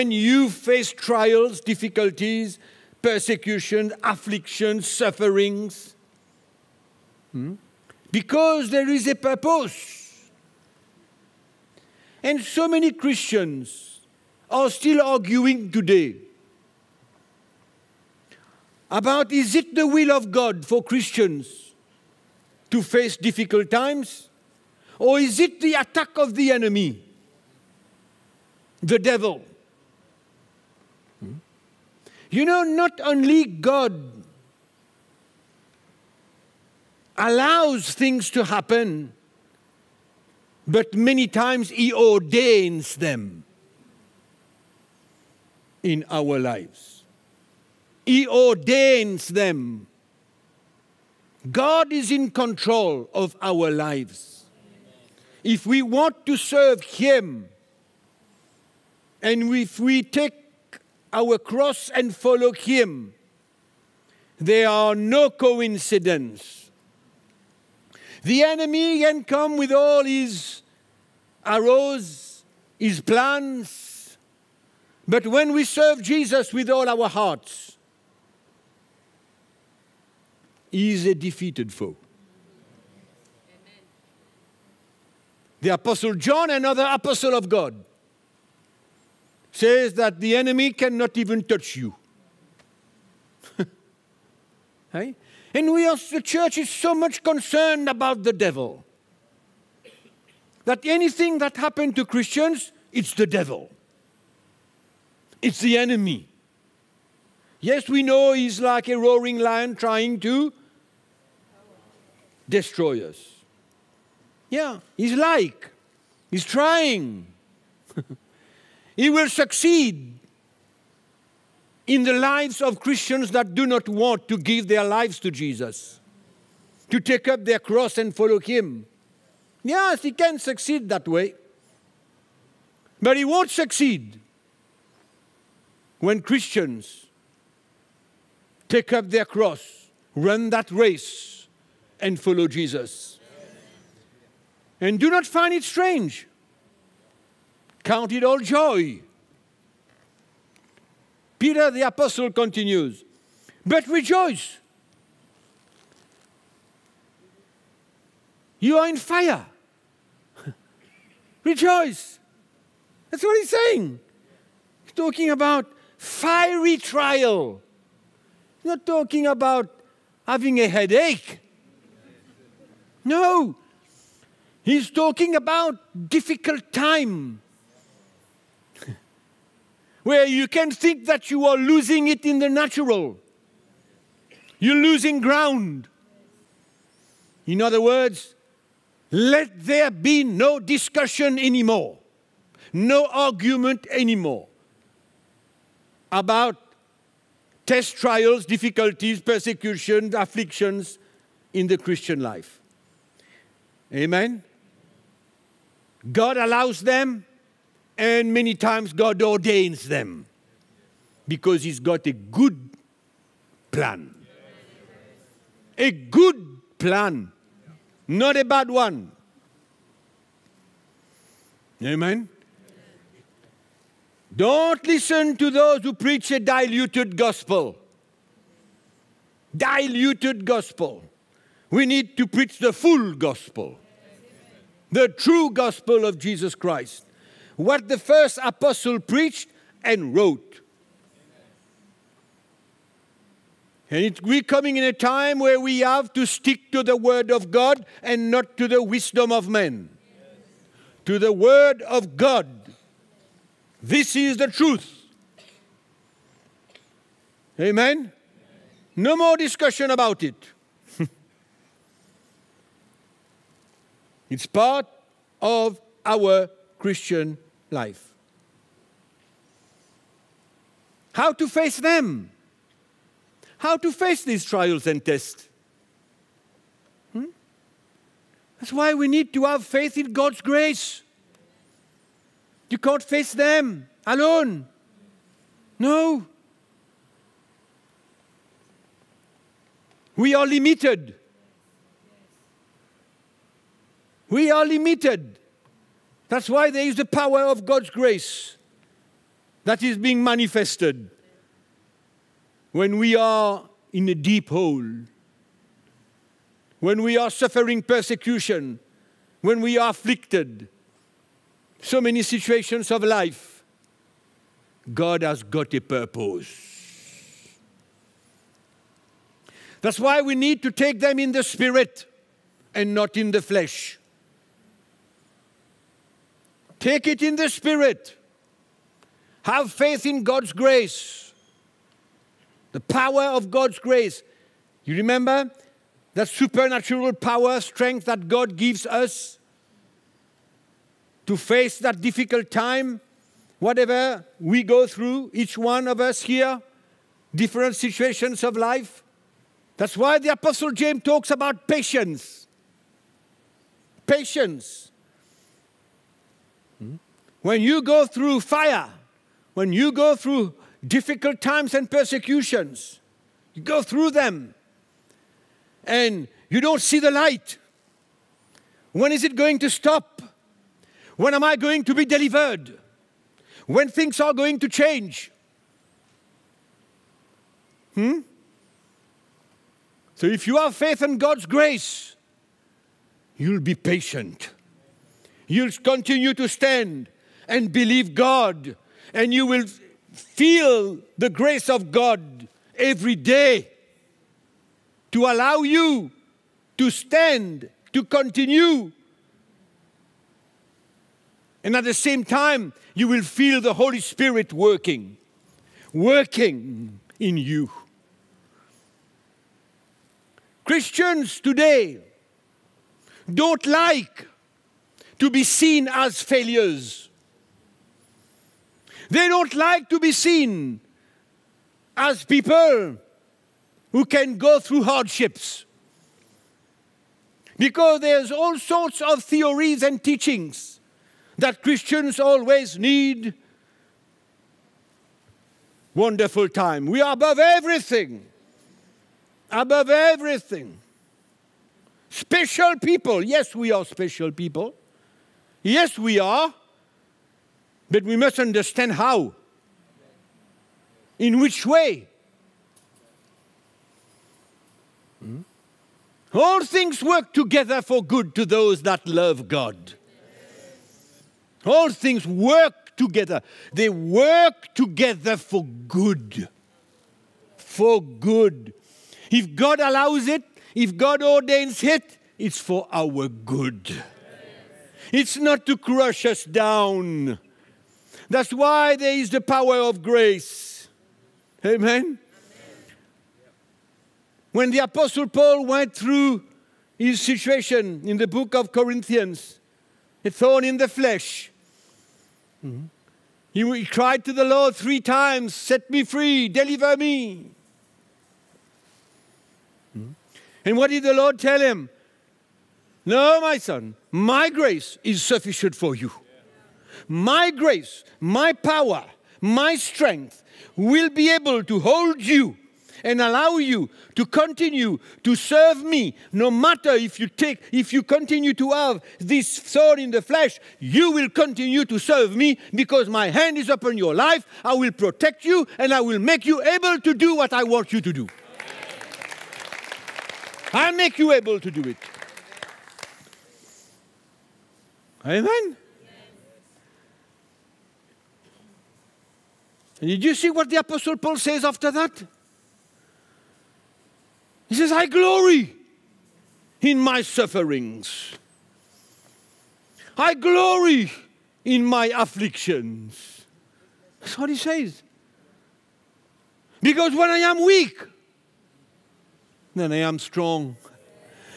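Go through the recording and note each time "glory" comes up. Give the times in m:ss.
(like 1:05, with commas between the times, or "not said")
9:05, 9:10.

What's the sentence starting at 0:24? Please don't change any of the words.
Or is it the attack of the enemy, the devil?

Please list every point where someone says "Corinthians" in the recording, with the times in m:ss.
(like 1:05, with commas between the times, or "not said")
8:08.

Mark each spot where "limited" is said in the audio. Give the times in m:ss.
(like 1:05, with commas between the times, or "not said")
4:50, 4:54.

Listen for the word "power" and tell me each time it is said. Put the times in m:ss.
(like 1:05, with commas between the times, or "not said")
4:57, 5:32, 5:37, 7:59, 8:28.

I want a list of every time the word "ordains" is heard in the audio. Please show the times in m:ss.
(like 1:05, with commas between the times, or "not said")
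0:41, 0:48, 3:29, 7:51.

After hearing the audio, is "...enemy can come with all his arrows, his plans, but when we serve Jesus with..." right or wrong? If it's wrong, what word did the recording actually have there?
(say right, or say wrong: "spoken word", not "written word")
right.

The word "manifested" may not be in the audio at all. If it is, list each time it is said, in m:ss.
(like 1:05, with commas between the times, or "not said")
5:00.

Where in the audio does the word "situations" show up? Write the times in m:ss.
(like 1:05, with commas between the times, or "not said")
5:12, 5:47, 8:07.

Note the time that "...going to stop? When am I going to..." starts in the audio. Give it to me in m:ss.
6:09.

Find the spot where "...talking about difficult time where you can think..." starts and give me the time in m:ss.
2:54.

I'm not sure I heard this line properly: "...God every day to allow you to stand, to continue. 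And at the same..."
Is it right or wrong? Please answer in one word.
right.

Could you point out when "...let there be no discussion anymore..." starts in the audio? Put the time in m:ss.
3:09.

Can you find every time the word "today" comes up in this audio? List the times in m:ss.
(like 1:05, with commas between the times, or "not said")
0:15, 6:51.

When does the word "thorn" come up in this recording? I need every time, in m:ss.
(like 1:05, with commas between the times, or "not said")
8:10, 8:39.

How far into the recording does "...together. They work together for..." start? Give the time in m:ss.
7:42.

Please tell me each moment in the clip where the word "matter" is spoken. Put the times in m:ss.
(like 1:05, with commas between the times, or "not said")
8:36.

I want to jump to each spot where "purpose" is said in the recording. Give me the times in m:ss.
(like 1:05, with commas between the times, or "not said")
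0:09, 5:15.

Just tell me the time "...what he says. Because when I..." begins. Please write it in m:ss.
9:14.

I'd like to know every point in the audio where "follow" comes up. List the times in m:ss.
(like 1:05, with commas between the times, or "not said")
1:02, 2:08, 2:22.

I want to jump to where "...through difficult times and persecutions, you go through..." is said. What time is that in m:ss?
6:00.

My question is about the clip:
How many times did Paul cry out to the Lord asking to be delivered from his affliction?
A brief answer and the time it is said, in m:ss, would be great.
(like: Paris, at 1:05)
3, at 8:14.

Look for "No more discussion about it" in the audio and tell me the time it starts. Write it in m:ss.
4:18.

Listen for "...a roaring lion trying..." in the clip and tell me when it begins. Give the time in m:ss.
1:48.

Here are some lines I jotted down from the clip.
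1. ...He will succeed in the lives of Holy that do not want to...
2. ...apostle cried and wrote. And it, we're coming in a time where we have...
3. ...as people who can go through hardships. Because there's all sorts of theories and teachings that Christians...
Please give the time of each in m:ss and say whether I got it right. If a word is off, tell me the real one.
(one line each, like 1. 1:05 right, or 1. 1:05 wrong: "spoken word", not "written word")
1. 1:58 wrong: "Christians", not "Holy"
2. 3:58 wrong: "preached", not "cried"
3. 7:01 right.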